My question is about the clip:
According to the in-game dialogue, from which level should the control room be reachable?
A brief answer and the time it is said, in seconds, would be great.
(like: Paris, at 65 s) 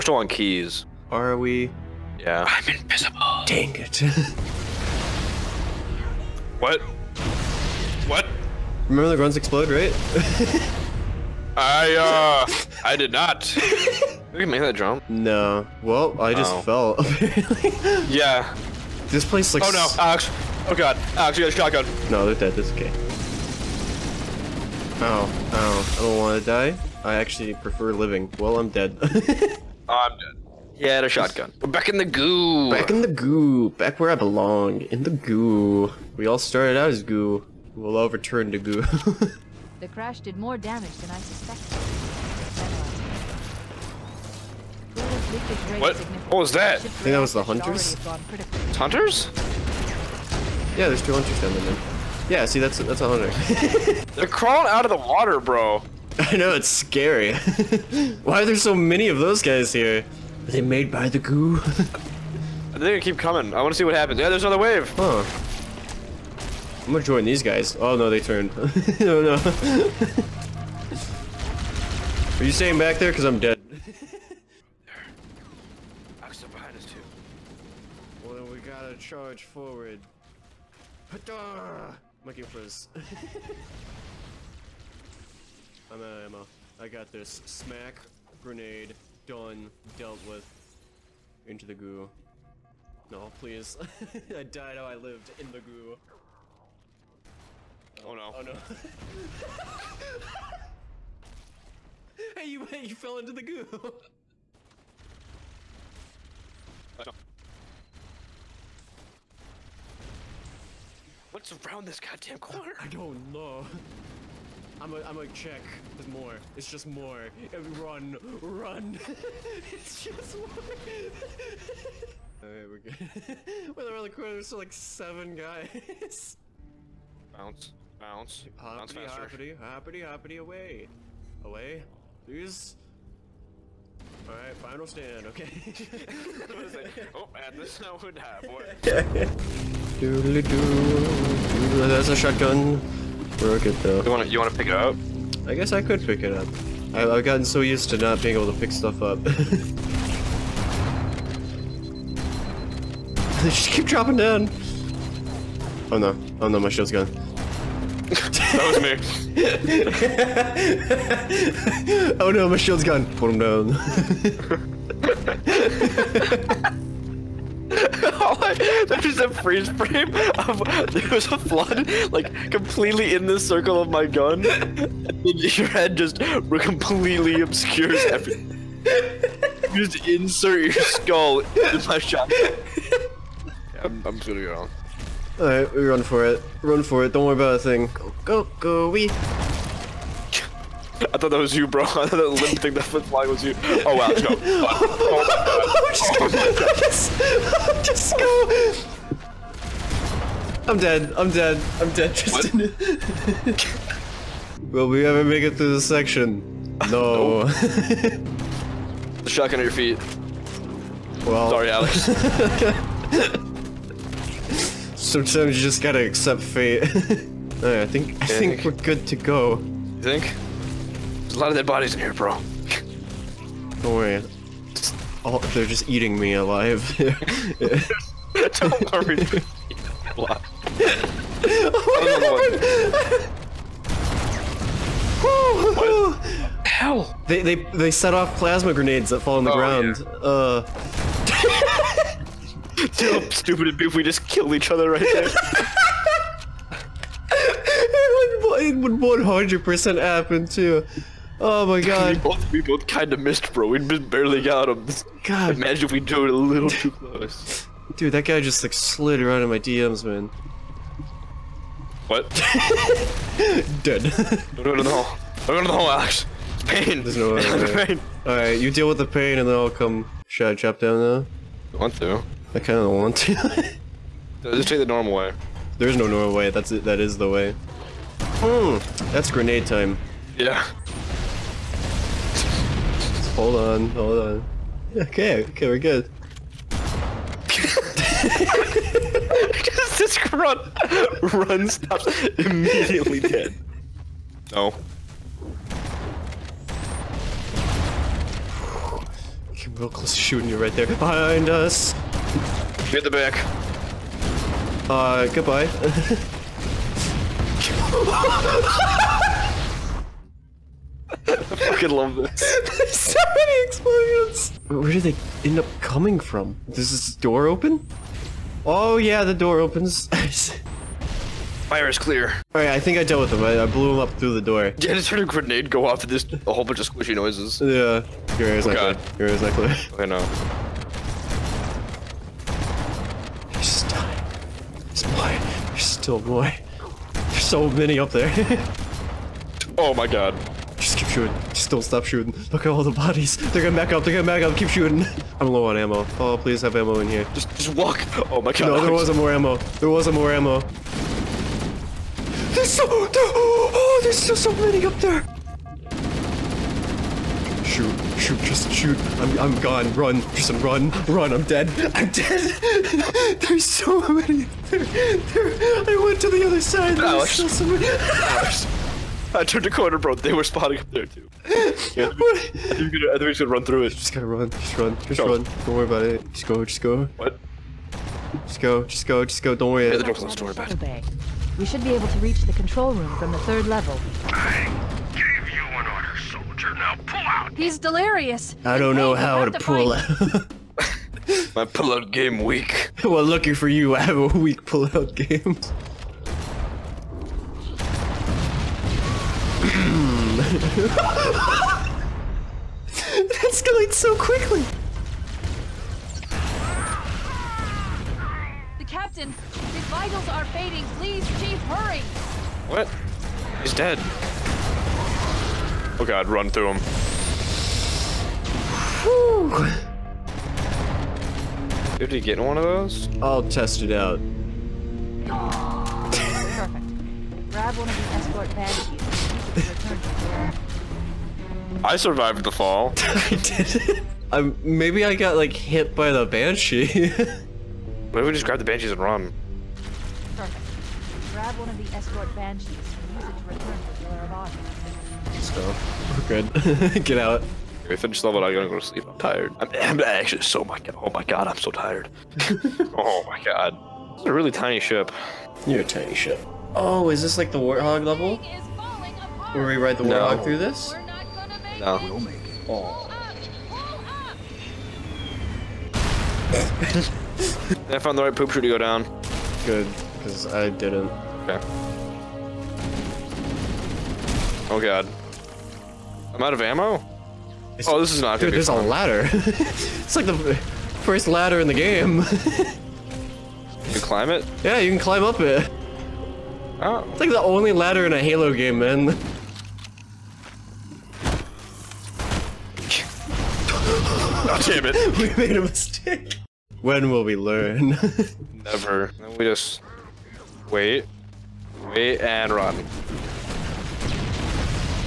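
The third level, at 383 s.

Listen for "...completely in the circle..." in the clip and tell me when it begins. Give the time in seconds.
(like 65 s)
172 s.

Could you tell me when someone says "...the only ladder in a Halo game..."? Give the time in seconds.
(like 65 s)
487 s.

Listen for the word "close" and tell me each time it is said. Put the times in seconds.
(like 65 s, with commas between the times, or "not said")
256 s, 299 s.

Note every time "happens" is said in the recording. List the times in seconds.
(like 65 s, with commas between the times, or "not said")
63 s, 250 s.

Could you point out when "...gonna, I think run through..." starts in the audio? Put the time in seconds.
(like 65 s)
373 s.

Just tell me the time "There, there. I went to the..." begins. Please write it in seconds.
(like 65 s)
364 s.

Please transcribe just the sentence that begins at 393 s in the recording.
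well, lucky for you, I have a weak pullout game.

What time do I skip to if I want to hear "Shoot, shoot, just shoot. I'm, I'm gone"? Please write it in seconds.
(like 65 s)
357 s.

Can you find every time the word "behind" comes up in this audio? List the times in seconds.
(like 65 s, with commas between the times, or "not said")
76 s, 300 s.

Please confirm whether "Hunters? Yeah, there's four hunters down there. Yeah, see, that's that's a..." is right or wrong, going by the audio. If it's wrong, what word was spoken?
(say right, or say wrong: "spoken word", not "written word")
wrong: "two", not "four".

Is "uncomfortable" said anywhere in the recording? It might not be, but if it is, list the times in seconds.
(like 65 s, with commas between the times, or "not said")
not said.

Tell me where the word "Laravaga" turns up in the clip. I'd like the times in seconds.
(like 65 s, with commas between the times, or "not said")
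445 s.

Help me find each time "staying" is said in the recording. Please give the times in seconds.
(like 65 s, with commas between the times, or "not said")
72 s.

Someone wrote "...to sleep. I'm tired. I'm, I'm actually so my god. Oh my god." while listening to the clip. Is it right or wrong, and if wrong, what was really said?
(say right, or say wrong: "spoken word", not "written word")
right.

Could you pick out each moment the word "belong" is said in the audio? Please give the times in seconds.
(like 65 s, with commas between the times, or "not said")
34 s.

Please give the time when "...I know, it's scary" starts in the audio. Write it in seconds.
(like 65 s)
56 s.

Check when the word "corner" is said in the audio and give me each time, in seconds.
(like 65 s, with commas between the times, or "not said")
112 s, 124 s, 369 s.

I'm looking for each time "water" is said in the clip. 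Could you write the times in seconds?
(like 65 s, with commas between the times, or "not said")
54 s.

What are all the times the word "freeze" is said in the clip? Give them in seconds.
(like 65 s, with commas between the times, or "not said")
169 s.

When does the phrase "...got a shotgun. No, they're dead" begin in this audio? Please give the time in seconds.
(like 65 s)
21 s.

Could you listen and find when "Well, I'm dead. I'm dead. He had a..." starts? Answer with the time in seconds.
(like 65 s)
28 s.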